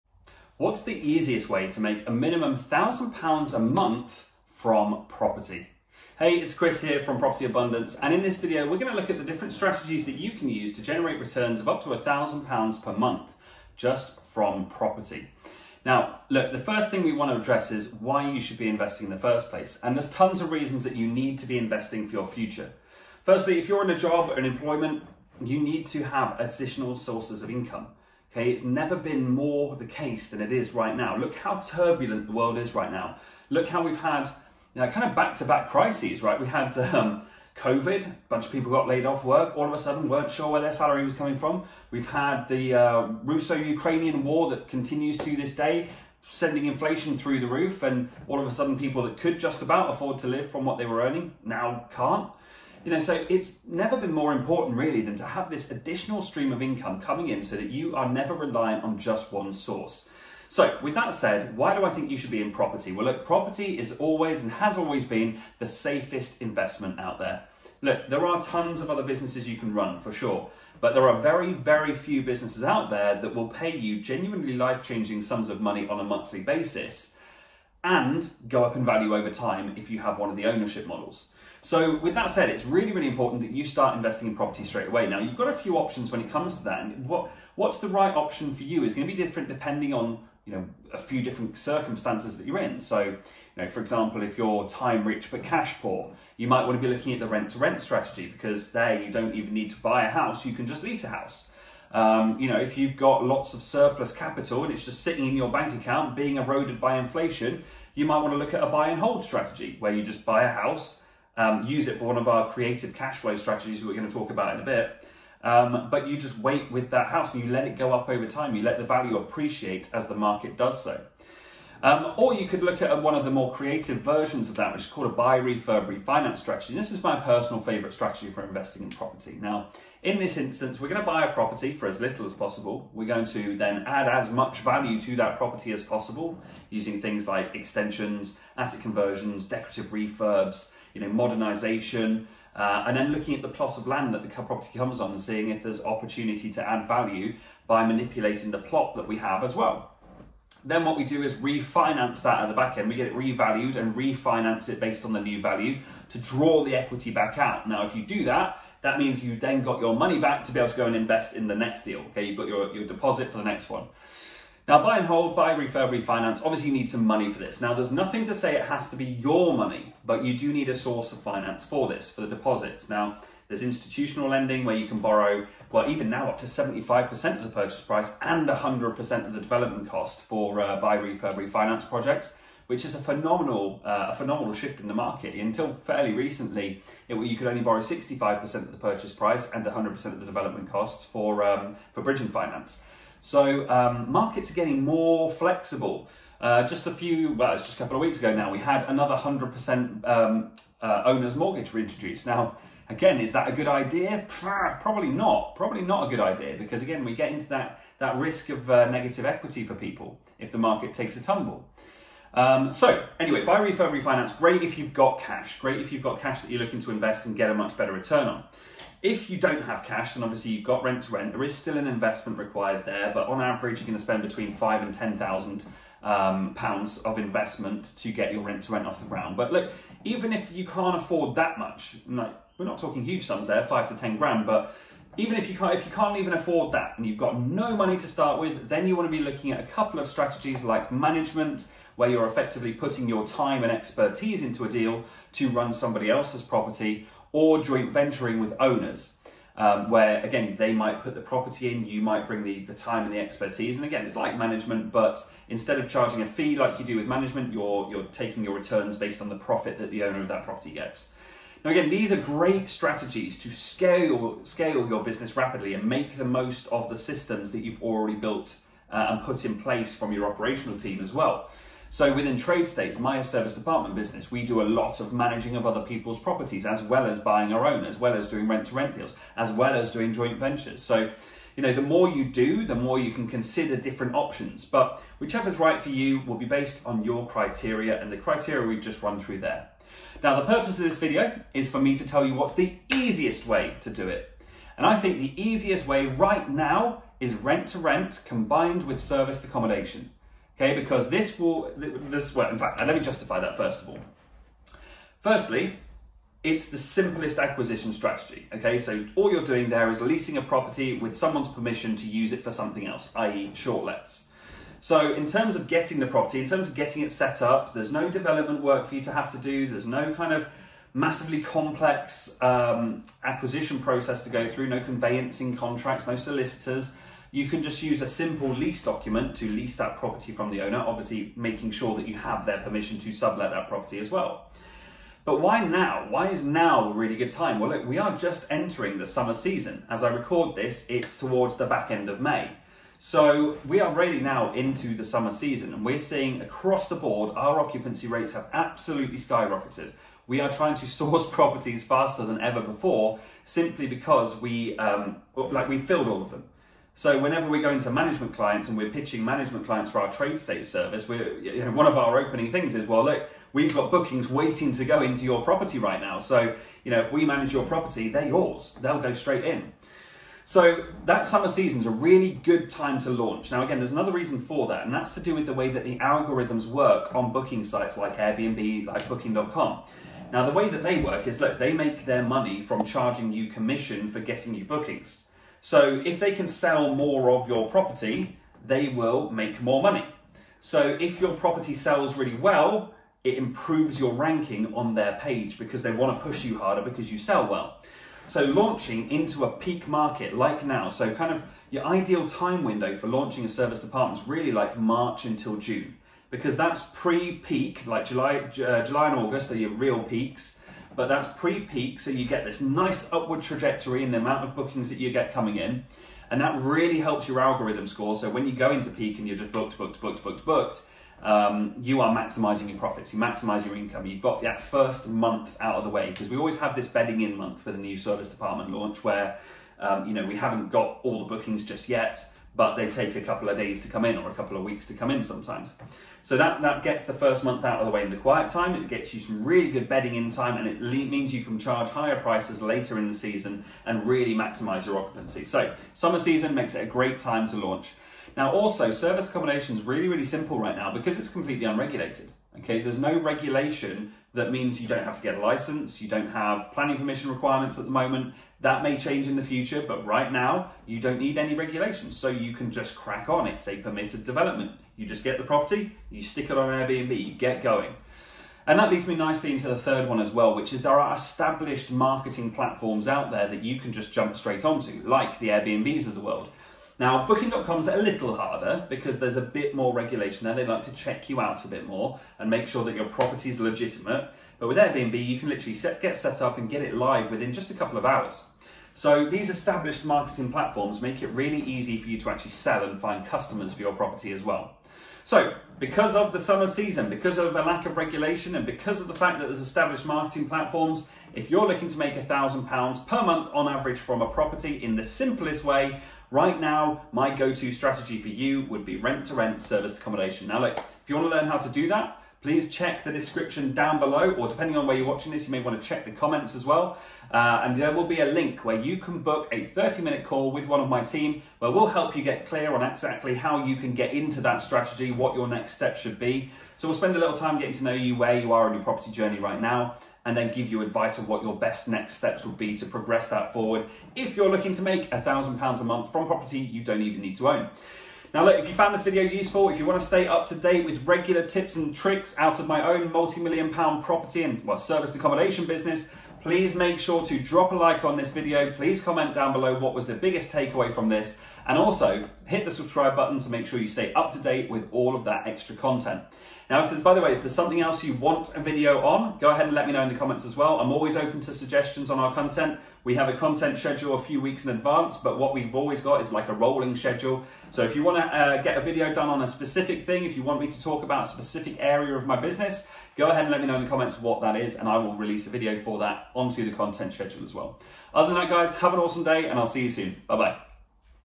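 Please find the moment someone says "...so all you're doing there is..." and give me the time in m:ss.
5:08.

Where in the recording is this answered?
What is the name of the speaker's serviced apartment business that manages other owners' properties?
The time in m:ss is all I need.
4:32.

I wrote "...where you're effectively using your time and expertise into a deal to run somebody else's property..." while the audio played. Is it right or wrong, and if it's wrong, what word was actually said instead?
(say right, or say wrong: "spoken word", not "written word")
wrong: "putting", not "using".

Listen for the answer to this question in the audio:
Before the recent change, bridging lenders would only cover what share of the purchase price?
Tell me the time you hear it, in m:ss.
3:07.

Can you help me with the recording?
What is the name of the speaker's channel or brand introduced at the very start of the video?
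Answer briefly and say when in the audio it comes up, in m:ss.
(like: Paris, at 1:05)
Property Abundance, at 0:07.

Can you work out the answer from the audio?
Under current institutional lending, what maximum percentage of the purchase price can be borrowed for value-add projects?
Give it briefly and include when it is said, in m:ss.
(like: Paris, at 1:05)
75%, at 2:56.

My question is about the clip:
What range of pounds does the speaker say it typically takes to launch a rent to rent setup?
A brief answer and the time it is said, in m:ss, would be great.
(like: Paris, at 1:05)
£5,000 to £10,000, at 3:44.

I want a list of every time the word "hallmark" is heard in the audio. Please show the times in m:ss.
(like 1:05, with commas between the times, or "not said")
not said.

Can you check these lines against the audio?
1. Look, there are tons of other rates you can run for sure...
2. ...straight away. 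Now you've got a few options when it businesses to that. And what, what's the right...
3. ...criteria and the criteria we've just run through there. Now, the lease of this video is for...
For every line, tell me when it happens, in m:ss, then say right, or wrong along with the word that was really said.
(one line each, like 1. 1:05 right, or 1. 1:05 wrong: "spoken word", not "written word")
1. 1:07 wrong: "businesses", not "rates"
2. 1:24 wrong: "comes", not "businesses"
3. 4:47 wrong: "purpose", not "lease".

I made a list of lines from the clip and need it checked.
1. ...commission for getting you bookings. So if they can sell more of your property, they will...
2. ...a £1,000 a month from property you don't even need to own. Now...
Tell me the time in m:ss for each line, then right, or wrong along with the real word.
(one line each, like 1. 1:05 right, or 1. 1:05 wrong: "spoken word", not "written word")
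1. 6:23 right
2. 8:55 right.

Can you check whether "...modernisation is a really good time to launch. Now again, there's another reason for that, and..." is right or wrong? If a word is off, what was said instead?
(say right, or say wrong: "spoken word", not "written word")
wrong: "season", not "modernisation".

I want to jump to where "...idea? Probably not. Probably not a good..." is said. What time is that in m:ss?
3:23.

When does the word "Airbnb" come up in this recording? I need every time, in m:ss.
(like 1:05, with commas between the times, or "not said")
6:18, 7:46, 7:55, 8:04.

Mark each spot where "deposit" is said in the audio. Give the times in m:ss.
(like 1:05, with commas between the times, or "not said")
2:42, 2:52.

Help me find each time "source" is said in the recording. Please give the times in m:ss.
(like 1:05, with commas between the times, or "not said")
0:26, 0:59, 2:50, 5:50.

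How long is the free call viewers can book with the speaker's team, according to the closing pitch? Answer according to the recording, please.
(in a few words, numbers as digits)
30 minutes.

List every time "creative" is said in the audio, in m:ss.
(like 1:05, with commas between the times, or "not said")
1:52, 2:03.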